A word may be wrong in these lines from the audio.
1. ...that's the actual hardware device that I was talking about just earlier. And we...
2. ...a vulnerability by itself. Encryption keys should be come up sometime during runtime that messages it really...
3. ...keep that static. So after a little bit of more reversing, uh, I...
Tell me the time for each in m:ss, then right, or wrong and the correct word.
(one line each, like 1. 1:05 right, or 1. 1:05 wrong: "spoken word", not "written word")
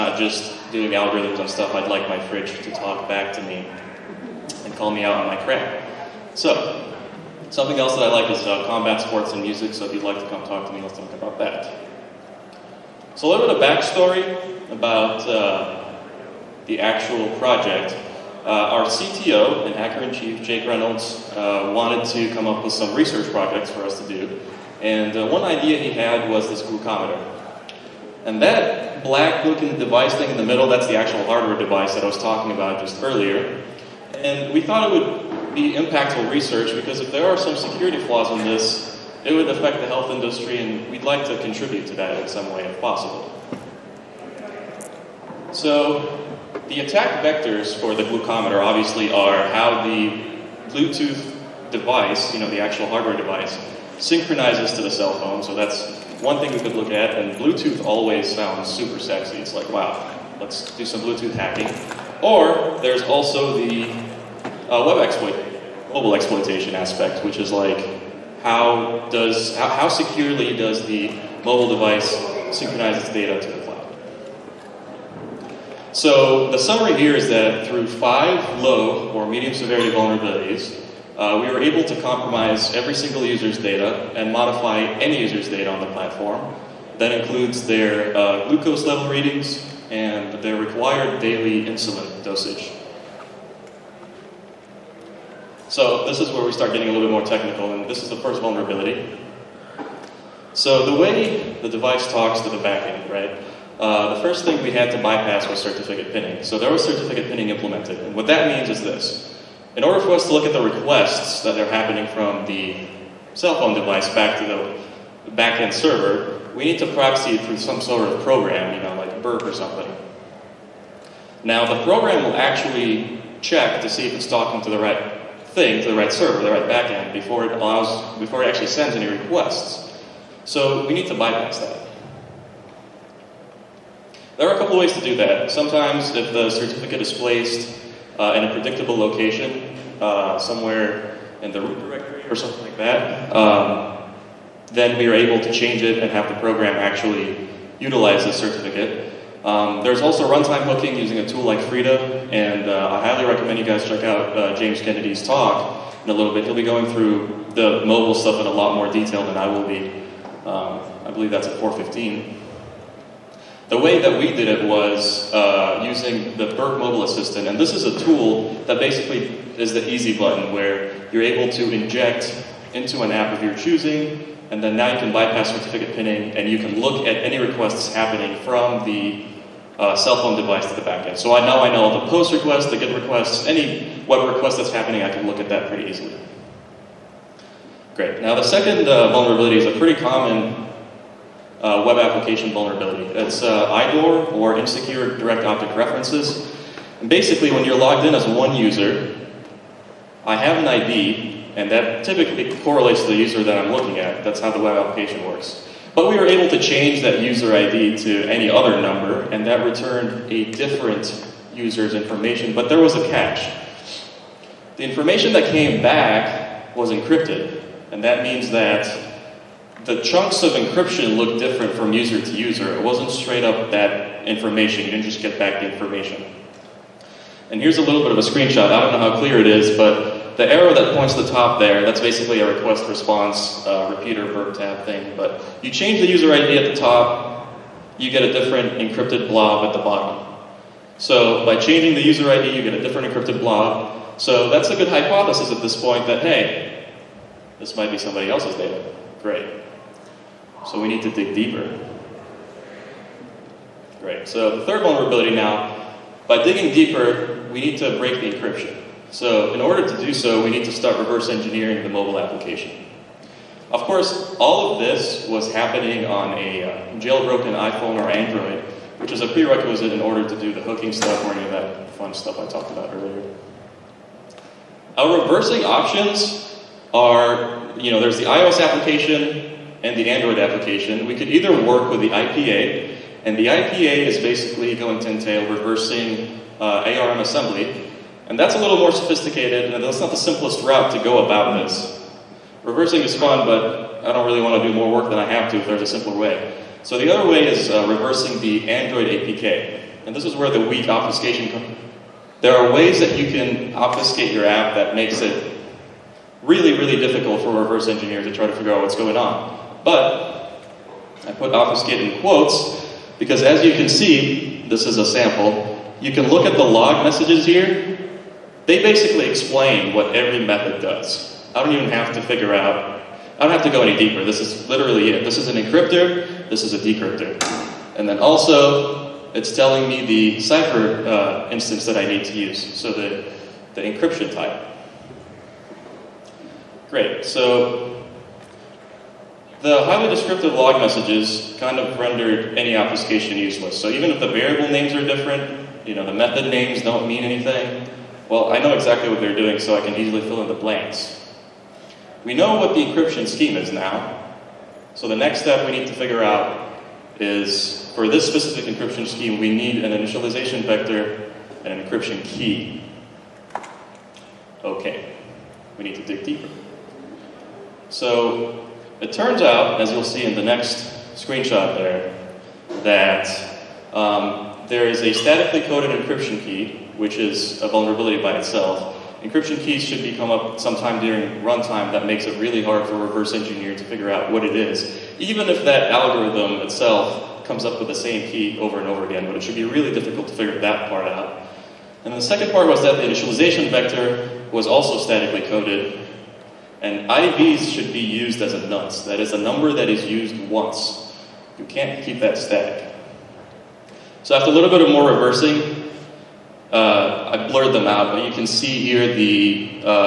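1. 0:30 right
2. 6:17 wrong: "makes", not "messages"
3. 6:42 right.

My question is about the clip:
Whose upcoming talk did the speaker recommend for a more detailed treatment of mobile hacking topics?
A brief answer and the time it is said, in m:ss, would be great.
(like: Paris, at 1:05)
James Kennedy, at 2:34.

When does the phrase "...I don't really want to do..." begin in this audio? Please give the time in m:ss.
4:54.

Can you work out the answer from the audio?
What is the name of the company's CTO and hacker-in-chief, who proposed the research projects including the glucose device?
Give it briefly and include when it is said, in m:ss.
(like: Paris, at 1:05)
Jake Reynolds, at 0:20.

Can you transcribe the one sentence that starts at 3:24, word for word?
That's how the web application works.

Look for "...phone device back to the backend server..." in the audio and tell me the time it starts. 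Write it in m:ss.
1:53.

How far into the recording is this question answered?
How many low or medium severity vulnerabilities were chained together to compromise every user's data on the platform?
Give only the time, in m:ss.
1:17.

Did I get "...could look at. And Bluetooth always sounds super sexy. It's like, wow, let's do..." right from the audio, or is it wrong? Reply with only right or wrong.
right.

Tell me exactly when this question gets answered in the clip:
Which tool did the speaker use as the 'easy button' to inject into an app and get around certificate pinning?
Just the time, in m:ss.
2:46.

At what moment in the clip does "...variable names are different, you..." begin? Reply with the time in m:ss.
5:44.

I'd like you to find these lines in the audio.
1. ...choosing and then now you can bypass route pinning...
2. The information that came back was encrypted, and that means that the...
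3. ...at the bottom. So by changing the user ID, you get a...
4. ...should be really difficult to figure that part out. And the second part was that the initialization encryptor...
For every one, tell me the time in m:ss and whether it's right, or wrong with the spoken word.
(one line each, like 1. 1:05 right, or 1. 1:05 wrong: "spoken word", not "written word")
1. 2:53 wrong: "certificate", not "route"
2. 3:34 right
3. 3:59 right
4. 6:29 wrong: "vector", not "encryptor".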